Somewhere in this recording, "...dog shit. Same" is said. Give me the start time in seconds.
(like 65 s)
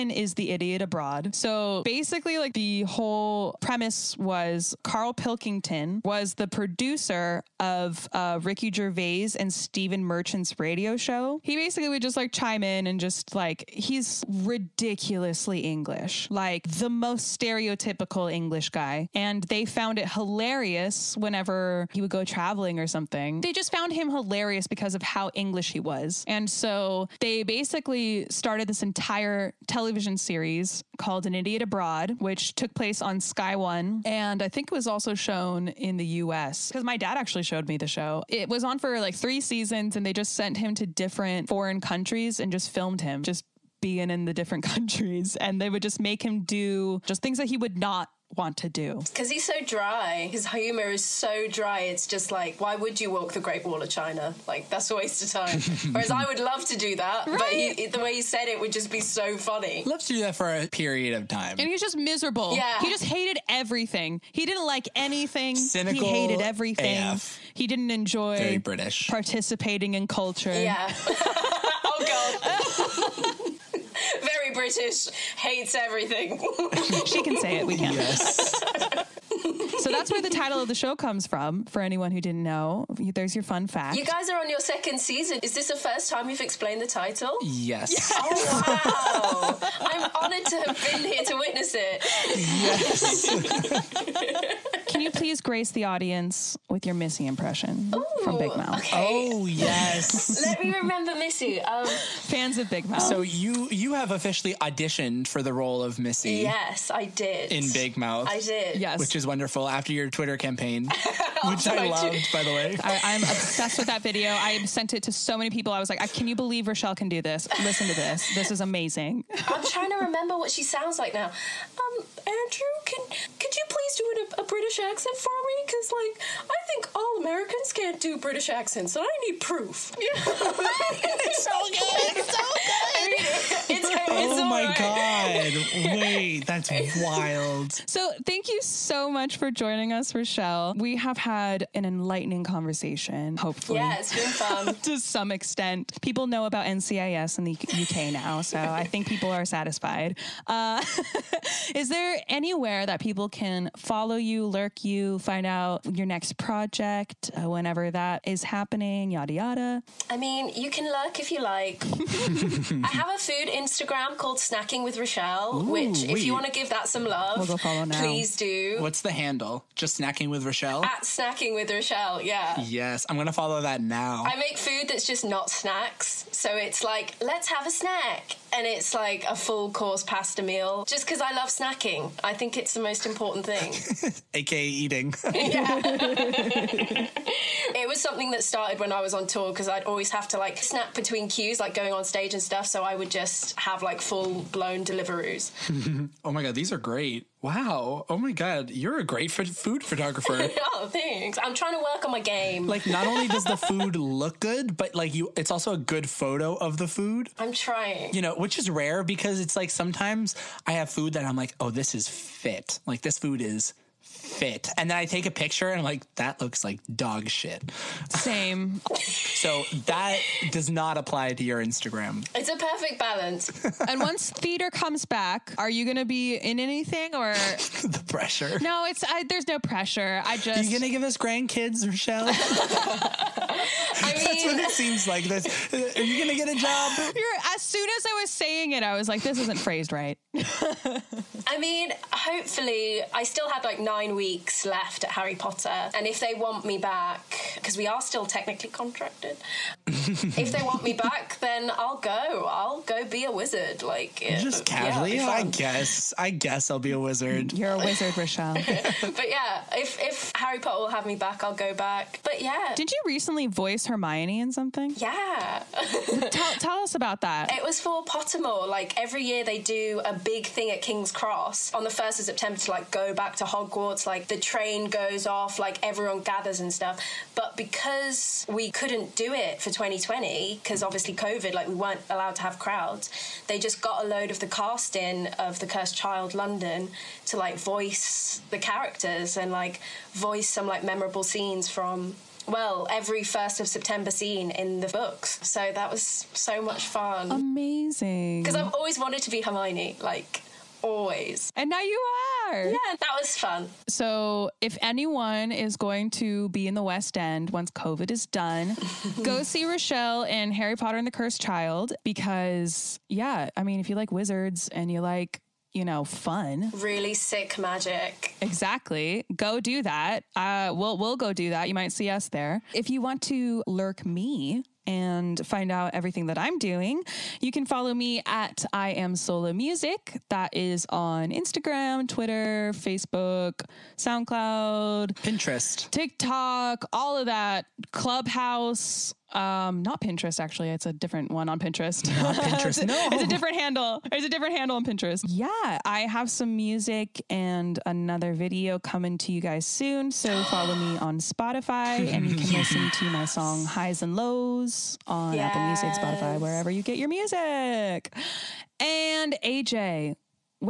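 216 s.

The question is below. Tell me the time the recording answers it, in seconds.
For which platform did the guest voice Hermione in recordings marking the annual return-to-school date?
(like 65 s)
268 s.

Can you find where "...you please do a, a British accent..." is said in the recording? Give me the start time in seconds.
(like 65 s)
123 s.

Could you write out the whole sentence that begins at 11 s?
He basically would just like chime in and just like, he's ridiculously English, like the most stereotypical English guy.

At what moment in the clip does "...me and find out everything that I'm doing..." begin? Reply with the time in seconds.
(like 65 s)
324 s.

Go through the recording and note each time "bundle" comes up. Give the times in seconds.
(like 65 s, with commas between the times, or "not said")
not said.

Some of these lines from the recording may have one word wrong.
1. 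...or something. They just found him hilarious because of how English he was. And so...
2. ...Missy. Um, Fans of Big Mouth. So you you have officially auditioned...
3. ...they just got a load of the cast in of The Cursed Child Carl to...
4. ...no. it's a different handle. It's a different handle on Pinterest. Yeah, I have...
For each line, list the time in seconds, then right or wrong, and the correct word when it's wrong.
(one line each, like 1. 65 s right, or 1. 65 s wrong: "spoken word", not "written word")
1. 22 s right
2. 101 s right
3. 283 s wrong: "London", not "Carl"
4. 342 s right.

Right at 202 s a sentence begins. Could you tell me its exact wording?
Like, not only does the food look good, but like you, it's also a good photo of the food.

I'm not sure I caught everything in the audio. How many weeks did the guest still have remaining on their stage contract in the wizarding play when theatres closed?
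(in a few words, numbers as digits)
9.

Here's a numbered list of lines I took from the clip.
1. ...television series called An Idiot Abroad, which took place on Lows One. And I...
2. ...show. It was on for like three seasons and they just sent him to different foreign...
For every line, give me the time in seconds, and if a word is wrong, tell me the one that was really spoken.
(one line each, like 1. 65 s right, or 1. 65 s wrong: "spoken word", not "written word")
1. 29 s wrong: "Sky", not "Lows"
2. 37 s right.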